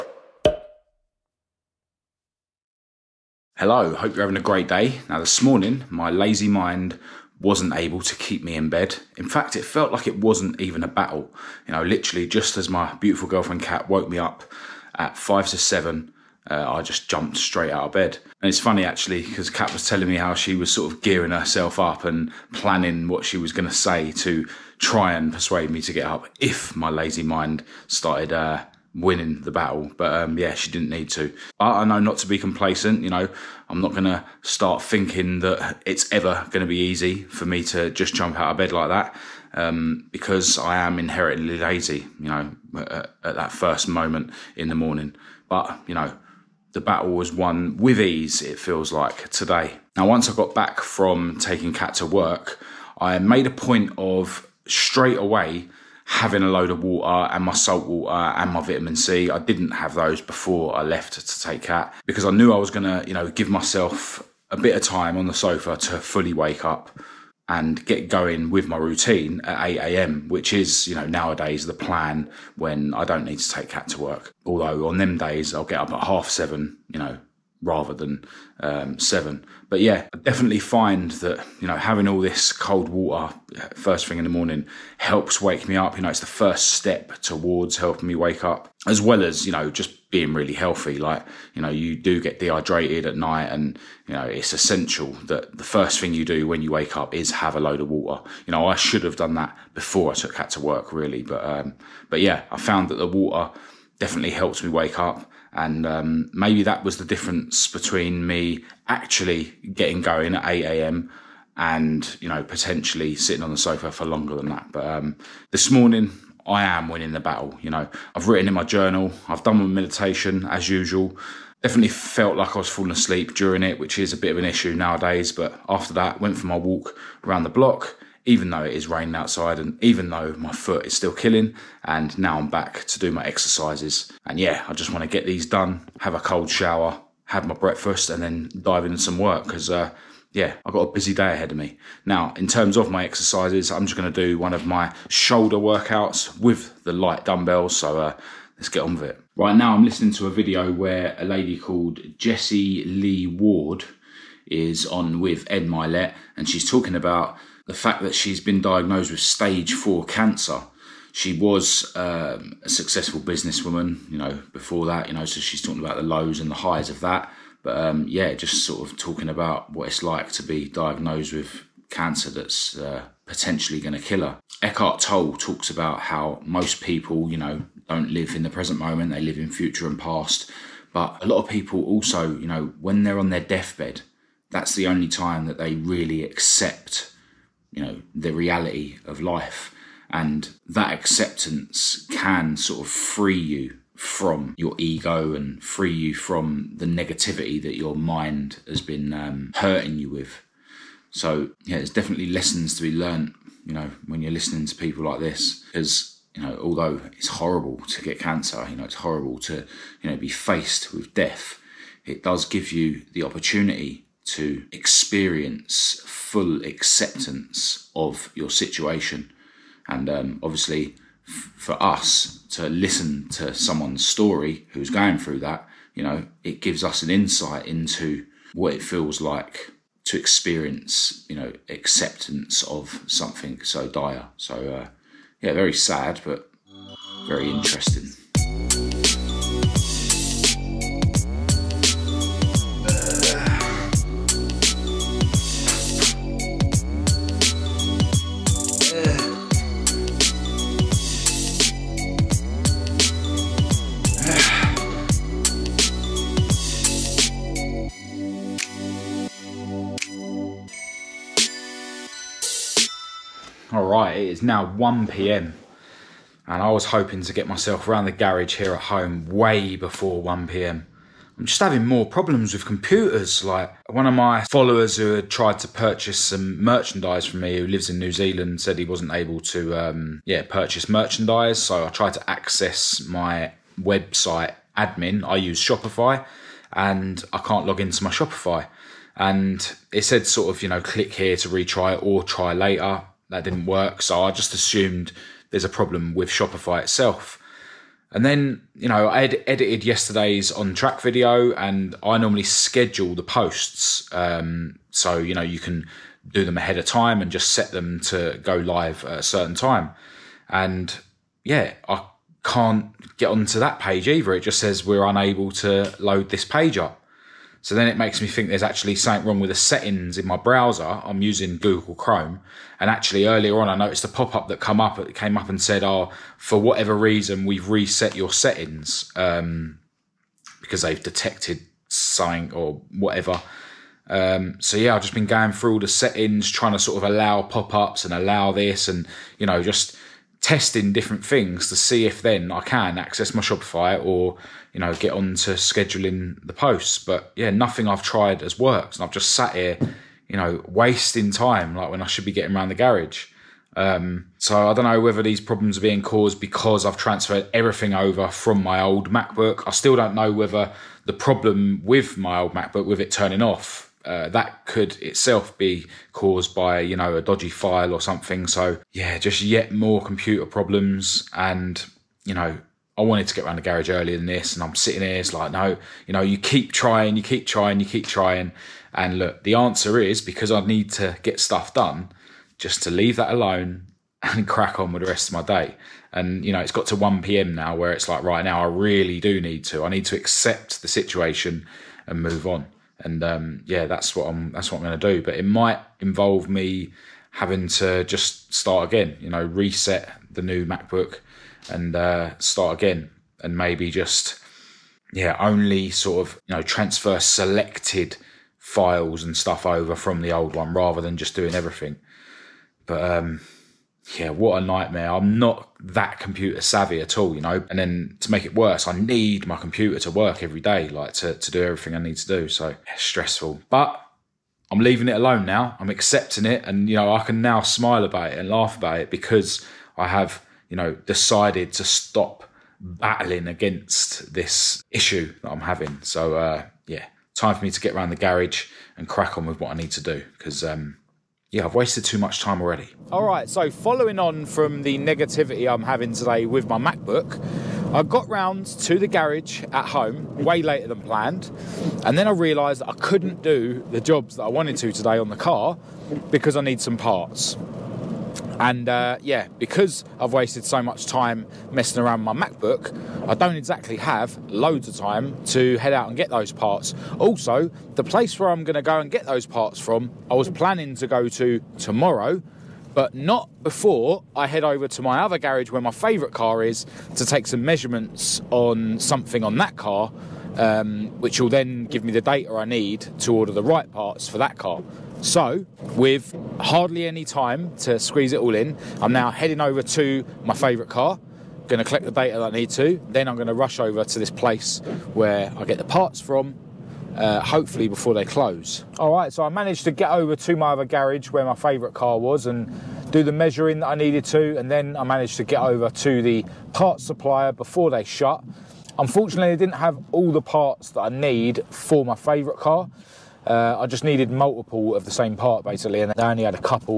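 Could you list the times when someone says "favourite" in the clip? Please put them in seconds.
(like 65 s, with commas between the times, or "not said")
475 s, 490 s, 501 s, 512 s.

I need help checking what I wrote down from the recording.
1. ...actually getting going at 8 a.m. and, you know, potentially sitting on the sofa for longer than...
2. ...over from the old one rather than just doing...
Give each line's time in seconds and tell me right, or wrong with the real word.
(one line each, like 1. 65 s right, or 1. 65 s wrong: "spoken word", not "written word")
1. 108 s right
2. 409 s right.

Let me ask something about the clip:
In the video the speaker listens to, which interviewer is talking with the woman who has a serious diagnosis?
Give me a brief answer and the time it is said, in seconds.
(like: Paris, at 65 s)
Ed Mylett, at 155 s.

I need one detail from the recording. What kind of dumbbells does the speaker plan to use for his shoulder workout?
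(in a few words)
light dumbbells.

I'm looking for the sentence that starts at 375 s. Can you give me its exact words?
It's like, no, you know, you keep trying, you keep trying, you keep trying.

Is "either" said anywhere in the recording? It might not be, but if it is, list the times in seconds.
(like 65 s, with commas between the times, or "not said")
314 s.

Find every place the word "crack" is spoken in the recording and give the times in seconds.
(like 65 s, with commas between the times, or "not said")
384 s, 439 s.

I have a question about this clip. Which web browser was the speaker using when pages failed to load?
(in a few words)
Google Chrome.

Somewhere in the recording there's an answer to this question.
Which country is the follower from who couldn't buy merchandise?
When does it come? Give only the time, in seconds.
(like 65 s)
277 s.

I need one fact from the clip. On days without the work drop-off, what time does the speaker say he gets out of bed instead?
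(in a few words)
half seven.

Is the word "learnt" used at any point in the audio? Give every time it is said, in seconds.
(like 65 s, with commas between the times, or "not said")
202 s.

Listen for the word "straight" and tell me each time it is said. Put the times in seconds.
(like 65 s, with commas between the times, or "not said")
17 s, 54 s.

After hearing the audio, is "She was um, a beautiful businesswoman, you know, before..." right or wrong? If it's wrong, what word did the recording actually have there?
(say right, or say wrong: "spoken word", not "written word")
wrong: "successful", not "beautiful".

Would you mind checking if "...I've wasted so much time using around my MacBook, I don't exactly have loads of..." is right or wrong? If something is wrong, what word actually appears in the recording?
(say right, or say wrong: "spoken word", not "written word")
wrong: "messing", not "using".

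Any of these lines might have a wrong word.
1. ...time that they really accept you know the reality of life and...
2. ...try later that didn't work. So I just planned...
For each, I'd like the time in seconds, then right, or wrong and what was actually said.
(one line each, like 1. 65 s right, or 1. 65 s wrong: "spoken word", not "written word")
1. 185 s right
2. 292 s wrong: "assumed", not "planned".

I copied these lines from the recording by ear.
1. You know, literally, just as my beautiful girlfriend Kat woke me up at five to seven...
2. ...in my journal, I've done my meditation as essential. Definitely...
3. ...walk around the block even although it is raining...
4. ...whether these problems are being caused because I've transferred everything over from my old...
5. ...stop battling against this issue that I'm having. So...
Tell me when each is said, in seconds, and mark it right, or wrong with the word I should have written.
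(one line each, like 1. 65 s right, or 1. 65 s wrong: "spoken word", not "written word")
1. 11 s right
2. 118 s wrong: "usual", not "essential"
3. 126 s wrong: "though", not "although"
4. 354 s right
5. 431 s right.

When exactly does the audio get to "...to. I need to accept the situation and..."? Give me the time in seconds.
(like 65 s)
389 s.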